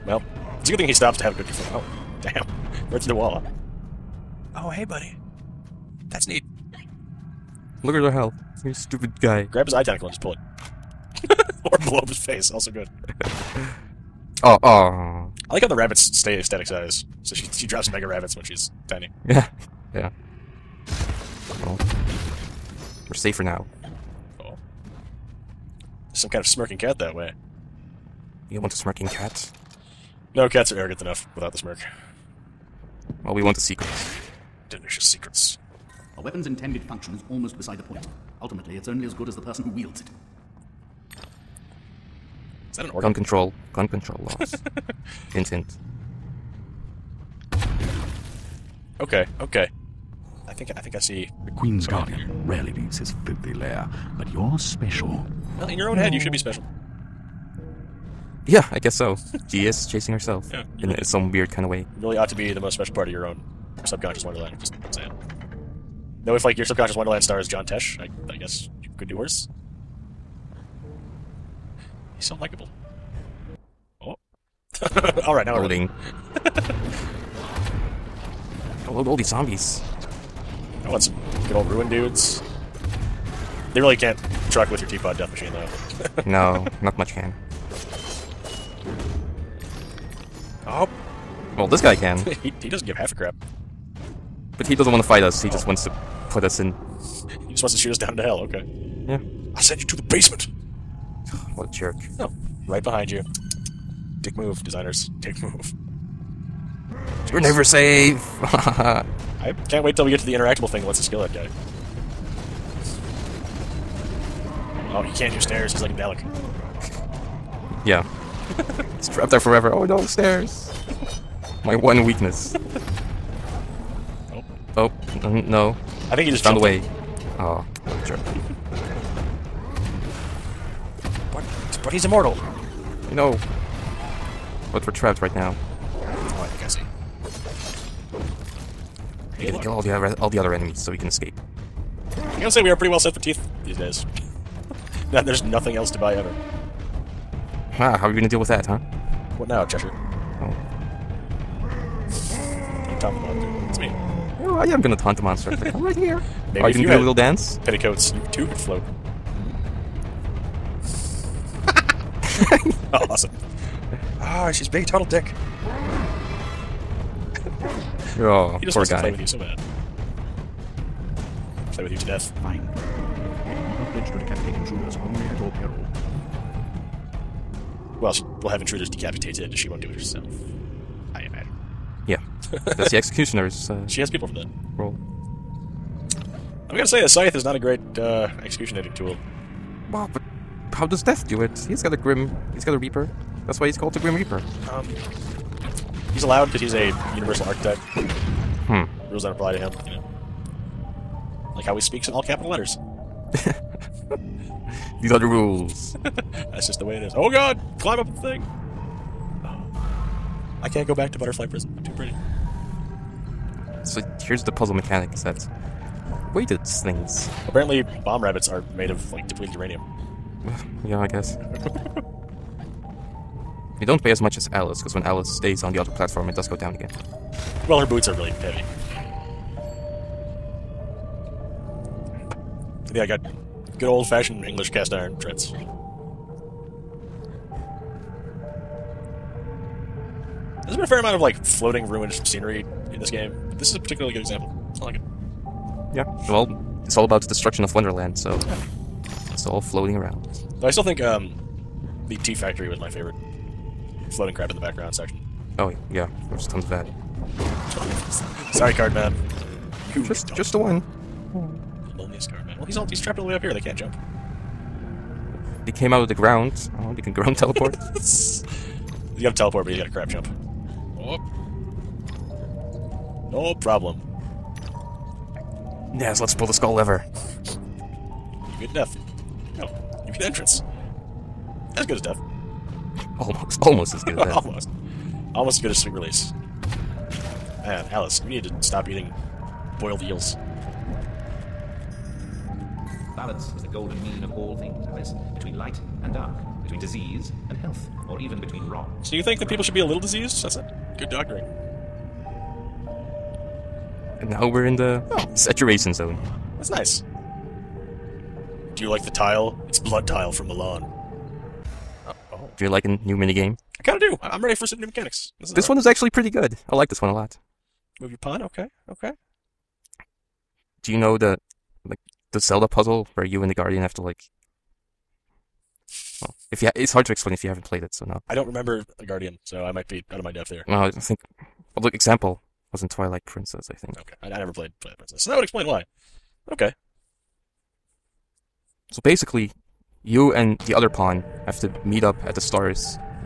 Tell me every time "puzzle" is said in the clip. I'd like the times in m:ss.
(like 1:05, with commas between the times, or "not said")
3:34, 5:22.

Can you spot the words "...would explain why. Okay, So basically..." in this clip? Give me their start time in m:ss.
5:35.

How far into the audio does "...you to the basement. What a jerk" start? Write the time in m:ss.
1:39.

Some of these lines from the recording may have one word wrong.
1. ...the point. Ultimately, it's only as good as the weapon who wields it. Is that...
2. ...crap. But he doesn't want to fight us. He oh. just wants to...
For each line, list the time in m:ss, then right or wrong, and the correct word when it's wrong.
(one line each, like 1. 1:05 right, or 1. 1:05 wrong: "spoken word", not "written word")
1. 0:37 wrong: "person", not "weapon"
2. 1:33 right.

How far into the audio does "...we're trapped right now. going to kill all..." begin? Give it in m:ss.
2:14.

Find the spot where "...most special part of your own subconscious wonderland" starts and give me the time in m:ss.
1:02.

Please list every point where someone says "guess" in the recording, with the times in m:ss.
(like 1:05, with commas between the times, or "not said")
0:58, 1:08, 3:41.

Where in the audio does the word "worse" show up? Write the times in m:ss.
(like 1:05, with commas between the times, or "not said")
1:09.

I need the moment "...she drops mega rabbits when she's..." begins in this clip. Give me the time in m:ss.
0:17.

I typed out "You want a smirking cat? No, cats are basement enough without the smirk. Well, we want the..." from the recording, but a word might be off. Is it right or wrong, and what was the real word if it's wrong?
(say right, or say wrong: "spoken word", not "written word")
wrong: "arrogant", not "basement".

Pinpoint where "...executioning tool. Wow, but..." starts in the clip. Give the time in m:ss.
3:08.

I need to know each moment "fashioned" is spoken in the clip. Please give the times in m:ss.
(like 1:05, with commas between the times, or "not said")
3:54.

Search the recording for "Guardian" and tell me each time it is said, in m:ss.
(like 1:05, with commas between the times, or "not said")
0:51, 5:23, 5:29.